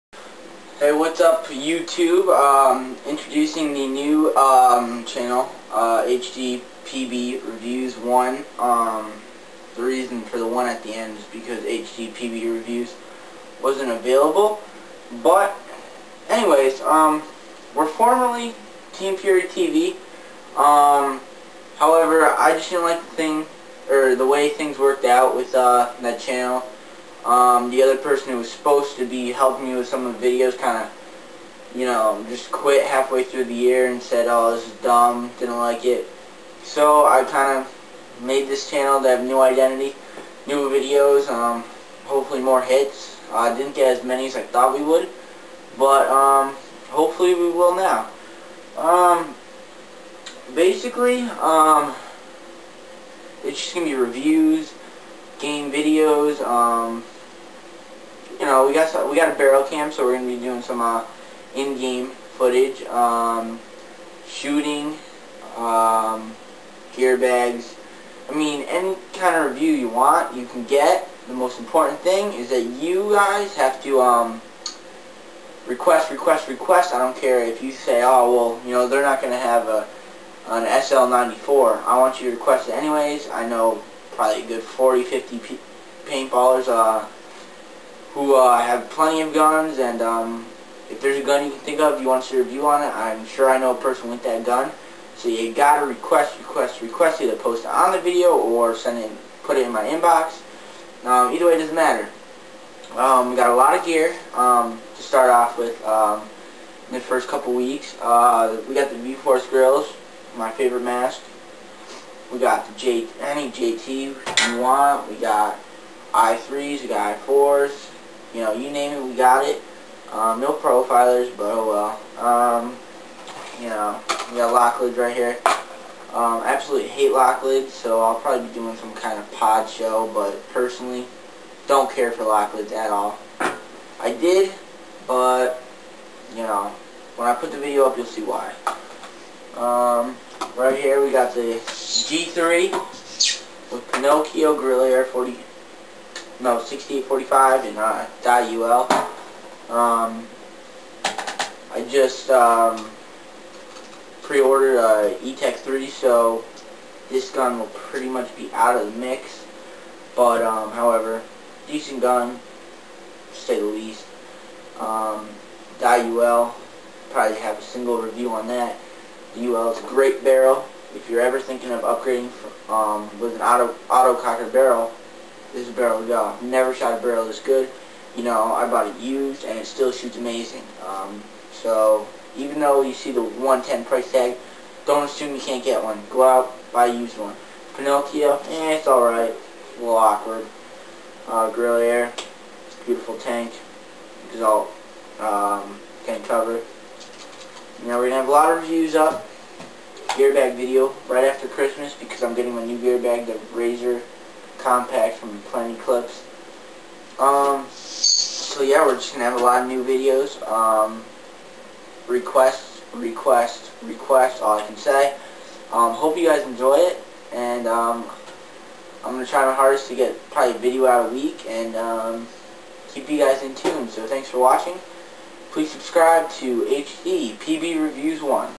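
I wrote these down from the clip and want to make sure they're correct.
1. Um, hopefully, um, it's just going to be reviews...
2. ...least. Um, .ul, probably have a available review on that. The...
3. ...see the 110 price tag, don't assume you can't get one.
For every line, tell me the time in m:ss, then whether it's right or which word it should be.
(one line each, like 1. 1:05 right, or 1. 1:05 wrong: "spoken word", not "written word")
1. 0:48 wrong: "basically", not "hopefully"
2. 2:43 wrong: "single", not "available"
3. 3:02 right.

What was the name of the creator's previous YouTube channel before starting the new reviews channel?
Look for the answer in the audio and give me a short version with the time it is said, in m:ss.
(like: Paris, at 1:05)
Team Fury TV, at 0:18.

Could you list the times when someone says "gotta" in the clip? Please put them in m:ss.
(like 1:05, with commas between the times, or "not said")
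1:35.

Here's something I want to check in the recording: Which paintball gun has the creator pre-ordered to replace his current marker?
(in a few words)
Etek 3.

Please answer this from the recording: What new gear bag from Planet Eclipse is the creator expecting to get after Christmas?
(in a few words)
Razor Compact.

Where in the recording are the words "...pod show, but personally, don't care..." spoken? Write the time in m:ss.
2:09.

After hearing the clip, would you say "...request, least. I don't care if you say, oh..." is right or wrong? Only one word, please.
wrong.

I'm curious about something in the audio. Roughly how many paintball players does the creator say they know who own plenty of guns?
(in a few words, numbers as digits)
40, 50.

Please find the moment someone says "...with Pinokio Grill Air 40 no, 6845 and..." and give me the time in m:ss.
2:23.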